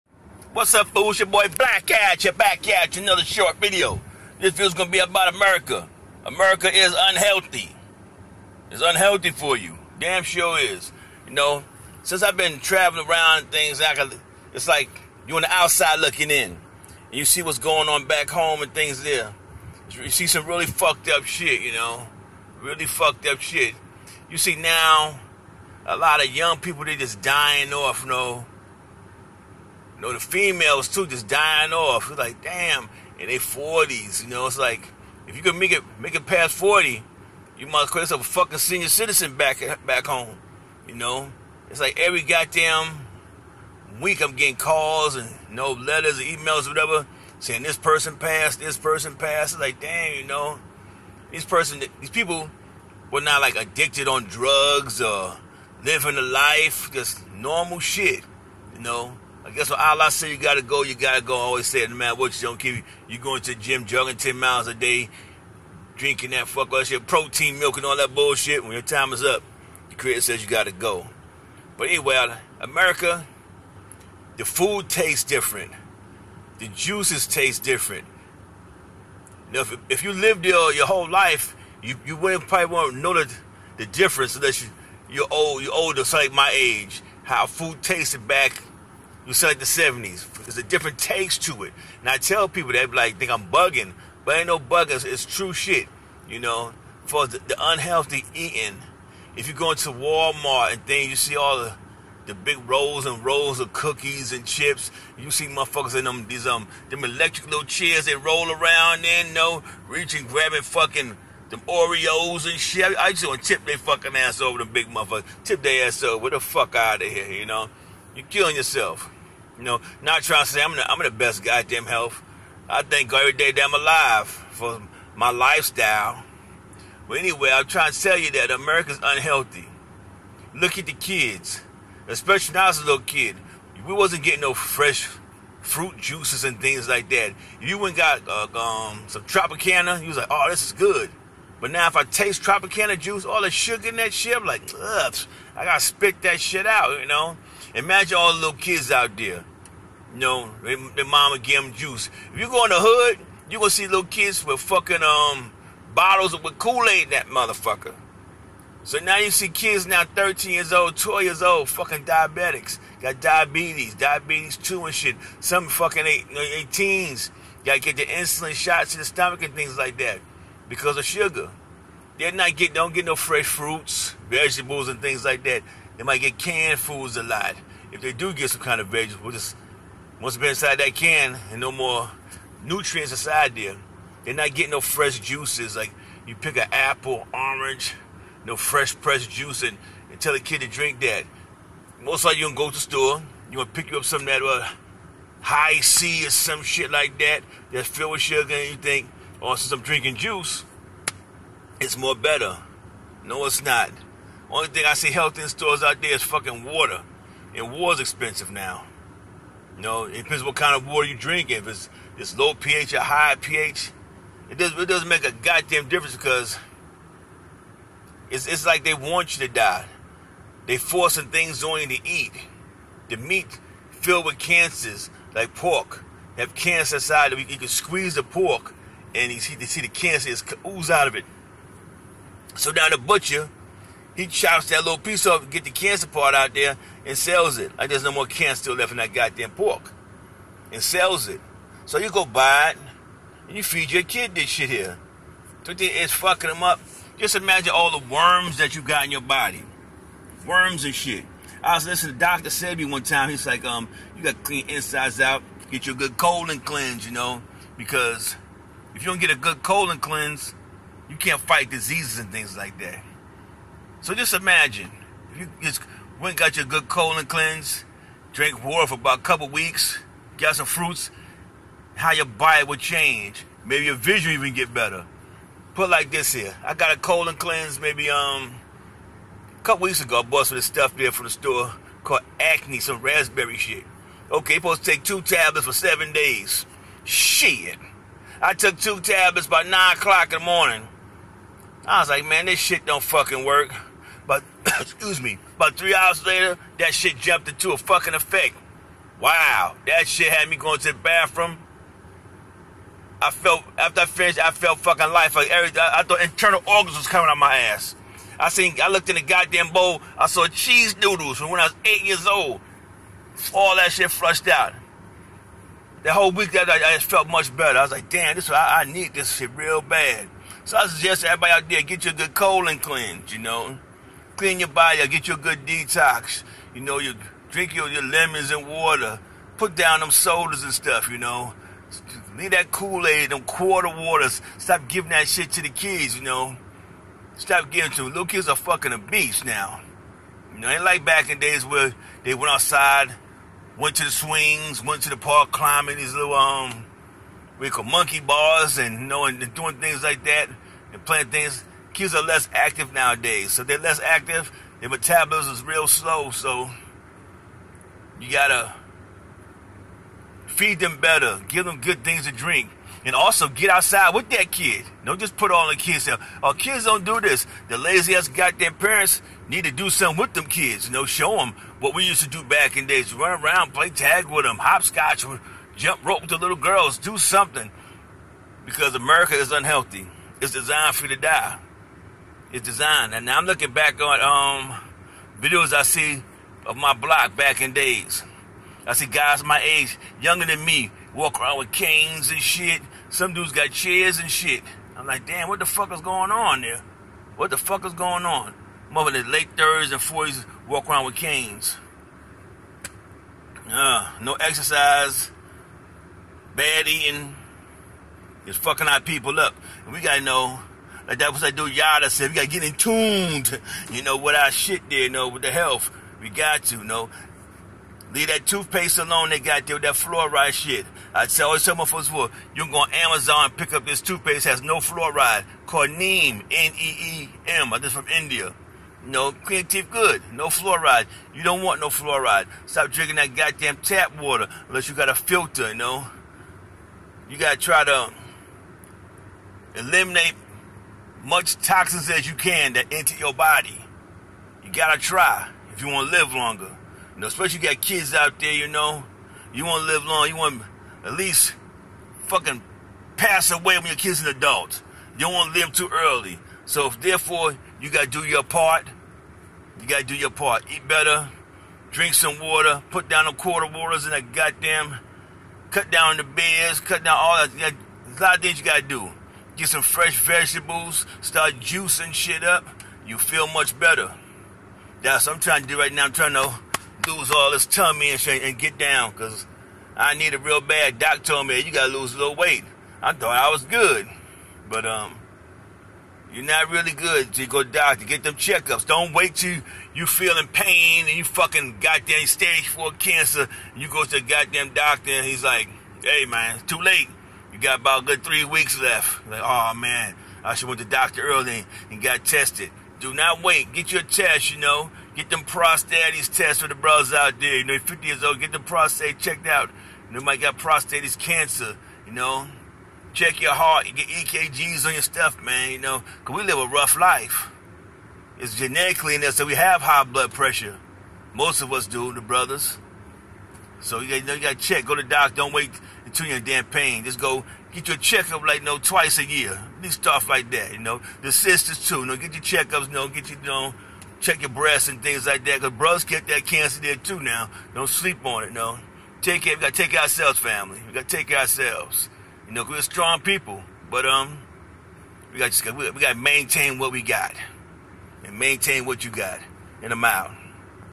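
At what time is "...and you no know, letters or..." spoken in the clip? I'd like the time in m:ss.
0:45.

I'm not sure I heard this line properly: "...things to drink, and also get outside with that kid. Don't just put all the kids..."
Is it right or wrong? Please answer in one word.
right.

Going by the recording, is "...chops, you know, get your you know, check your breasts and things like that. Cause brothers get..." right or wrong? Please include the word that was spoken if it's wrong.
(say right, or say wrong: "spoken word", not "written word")
wrong: "checkups", not "chops".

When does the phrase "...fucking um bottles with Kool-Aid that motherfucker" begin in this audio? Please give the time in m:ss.
2:34.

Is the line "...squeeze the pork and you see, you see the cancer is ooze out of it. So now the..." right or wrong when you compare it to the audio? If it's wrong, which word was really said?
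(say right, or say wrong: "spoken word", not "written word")
right.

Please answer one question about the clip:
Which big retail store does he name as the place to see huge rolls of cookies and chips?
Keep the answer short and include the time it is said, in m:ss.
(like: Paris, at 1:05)
Walmart, at 1:39.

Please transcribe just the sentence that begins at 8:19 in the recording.
Like, oh man, I should went to doctor early and got tested.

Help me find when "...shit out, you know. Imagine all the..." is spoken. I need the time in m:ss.
2:26.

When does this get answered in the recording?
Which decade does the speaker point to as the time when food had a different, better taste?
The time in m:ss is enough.
1:29.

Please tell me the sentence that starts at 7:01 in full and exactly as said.
I tell always tell my folks for you are go on Amazon and pick up this toothpaste has no fluoride.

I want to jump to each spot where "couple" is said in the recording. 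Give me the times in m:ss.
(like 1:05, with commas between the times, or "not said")
4:29, 4:39.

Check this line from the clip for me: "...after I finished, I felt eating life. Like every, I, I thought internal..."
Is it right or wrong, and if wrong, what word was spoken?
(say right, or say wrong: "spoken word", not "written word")
wrong: "fucking", not "eating".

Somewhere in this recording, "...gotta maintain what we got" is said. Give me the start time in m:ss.
9:06.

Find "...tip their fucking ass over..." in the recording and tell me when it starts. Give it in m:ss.
1:53.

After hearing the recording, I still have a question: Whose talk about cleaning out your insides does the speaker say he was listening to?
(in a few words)
Dr. Sebi.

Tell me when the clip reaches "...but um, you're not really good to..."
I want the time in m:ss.
8:04.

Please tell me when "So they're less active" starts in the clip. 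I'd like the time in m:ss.
5:53.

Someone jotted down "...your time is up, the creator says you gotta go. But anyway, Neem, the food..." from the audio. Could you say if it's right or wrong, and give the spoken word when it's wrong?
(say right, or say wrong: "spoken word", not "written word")
wrong: "America", not "Neem".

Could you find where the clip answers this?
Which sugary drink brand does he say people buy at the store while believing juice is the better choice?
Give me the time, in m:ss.
3:15.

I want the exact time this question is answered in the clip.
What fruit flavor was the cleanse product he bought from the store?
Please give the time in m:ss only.
4:43.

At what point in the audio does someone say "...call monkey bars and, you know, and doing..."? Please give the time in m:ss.
5:47.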